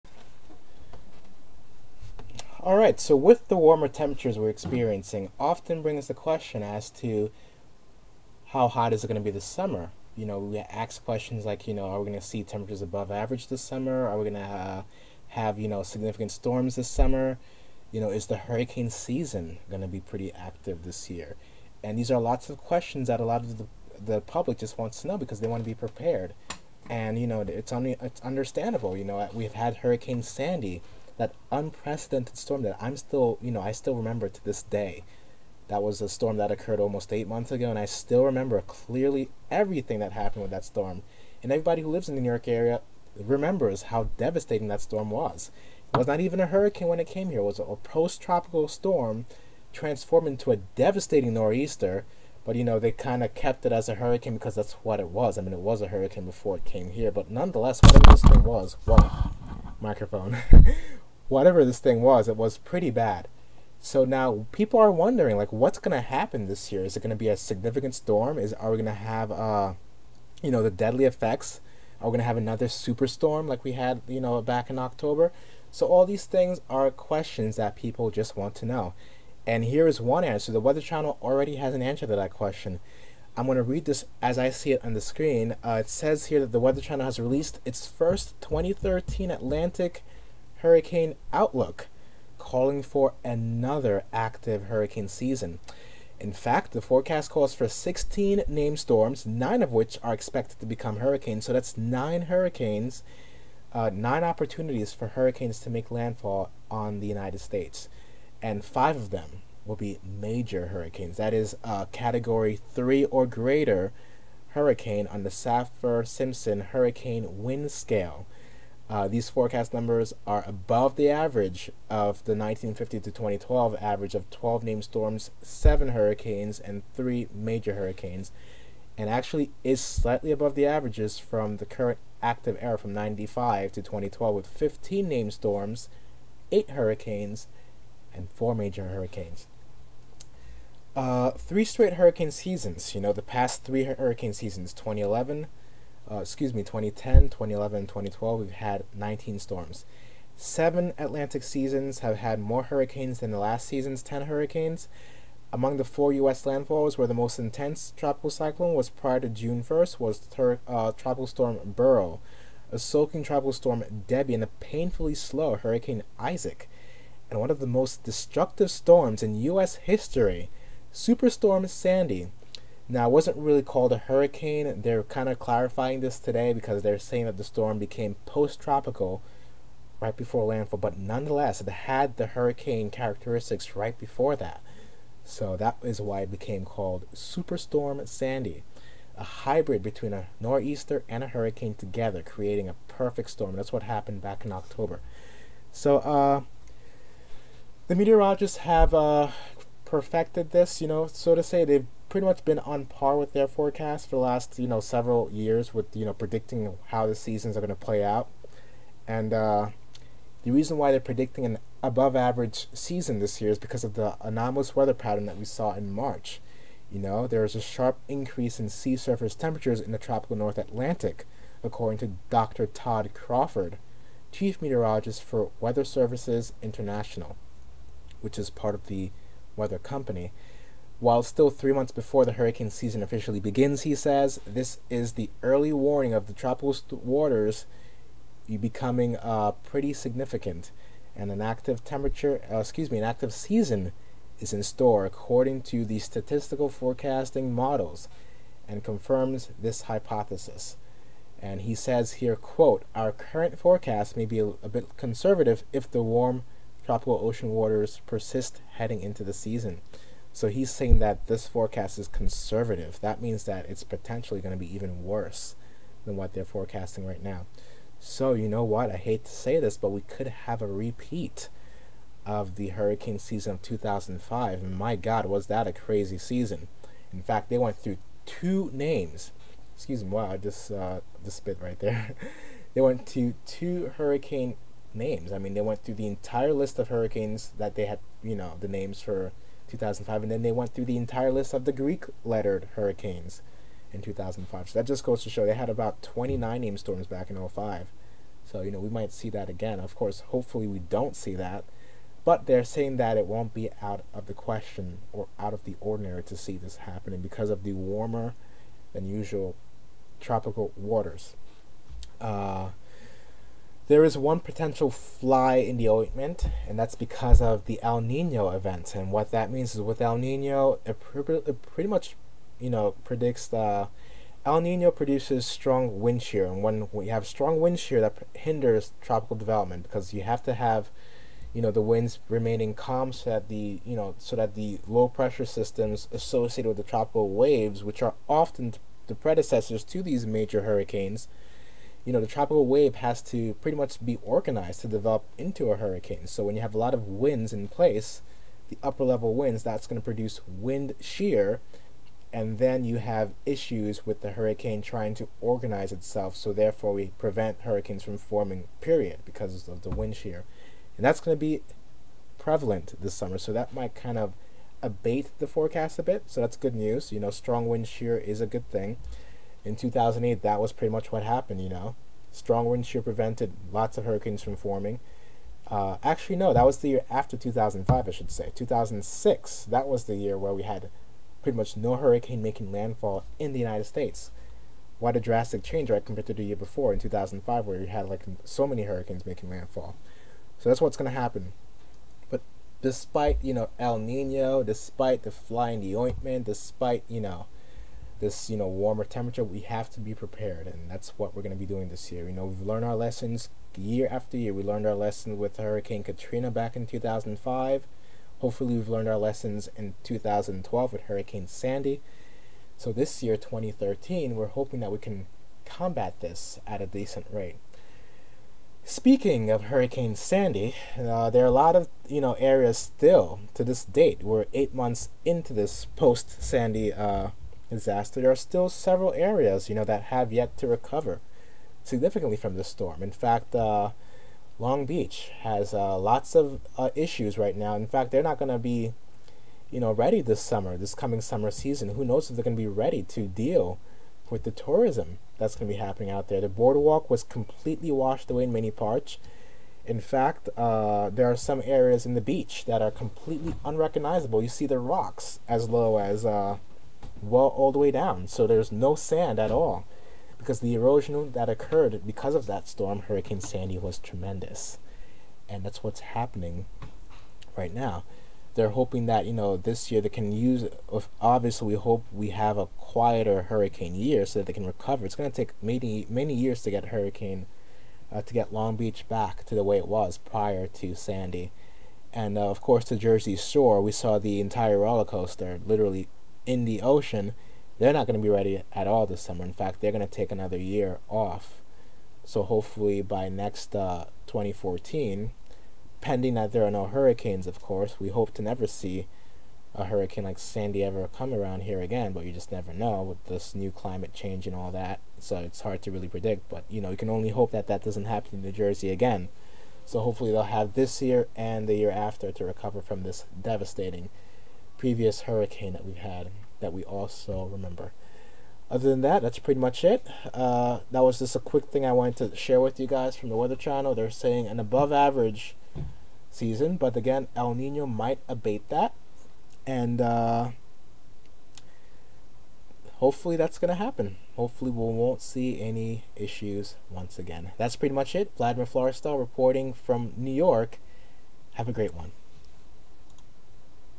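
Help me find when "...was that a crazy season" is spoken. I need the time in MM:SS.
04:35.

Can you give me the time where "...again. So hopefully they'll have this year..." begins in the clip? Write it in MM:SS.
08:28.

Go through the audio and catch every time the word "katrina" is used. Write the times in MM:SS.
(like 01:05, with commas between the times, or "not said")
06:46.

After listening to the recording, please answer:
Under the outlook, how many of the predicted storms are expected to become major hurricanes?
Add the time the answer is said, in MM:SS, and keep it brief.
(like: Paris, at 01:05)
5, at 01:48.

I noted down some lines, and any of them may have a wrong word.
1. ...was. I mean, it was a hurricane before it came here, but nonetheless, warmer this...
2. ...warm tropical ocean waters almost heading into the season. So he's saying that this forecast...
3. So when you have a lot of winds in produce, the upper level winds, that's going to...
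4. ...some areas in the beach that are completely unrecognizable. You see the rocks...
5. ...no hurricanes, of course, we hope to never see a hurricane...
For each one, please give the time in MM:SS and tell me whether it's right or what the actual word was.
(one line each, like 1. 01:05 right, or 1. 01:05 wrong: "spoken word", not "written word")
1. 00:55 wrong: "whatever", not "warmer"
2. 04:16 wrong: "persist", not "almost"
3. 05:46 wrong: "place", not "produce"
4. 07:31 right
5. 08:16 right.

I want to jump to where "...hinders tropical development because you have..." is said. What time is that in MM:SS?
05:28.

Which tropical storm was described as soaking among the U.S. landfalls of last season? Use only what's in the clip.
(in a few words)
Debbie.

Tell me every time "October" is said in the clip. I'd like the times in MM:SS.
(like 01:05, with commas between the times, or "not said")
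01:14, 03:14.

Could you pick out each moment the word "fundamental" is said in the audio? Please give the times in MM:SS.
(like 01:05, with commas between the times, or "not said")
not said.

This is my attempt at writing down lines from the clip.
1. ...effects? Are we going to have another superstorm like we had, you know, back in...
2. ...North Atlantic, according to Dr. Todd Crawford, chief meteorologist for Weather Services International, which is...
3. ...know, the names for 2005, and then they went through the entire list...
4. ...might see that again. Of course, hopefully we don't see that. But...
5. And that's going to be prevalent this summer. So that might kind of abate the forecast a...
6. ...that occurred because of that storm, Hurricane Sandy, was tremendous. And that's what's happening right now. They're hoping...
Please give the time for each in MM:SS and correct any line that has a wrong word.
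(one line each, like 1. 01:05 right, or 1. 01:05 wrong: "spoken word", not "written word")
1. 01:11 right
2. 03:40 right
3. 04:48 right
4. 04:58 right
5. 06:00 right
6. 07:41 right.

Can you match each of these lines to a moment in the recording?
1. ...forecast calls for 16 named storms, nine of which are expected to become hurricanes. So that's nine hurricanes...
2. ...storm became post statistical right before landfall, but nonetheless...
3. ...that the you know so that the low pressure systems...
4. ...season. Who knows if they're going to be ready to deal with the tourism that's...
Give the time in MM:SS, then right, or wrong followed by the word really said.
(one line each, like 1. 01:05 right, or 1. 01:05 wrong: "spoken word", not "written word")
1. 01:36 right
2. 02:57 wrong: "tropical", not "statistical"
3. 05:33 right
4. 07:21 right.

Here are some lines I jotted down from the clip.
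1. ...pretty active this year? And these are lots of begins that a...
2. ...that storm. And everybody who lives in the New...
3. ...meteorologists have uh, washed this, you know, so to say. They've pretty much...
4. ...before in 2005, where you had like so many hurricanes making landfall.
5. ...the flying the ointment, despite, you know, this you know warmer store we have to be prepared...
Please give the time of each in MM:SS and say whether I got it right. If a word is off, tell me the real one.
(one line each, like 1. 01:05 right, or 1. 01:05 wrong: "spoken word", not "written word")
1. 00:19 wrong: "questions", not "begins"
2. 00:40 right
3. 03:17 wrong: "perfected", not "washed"
4. 06:26 right
5. 06:35 wrong: "temperature", not "store".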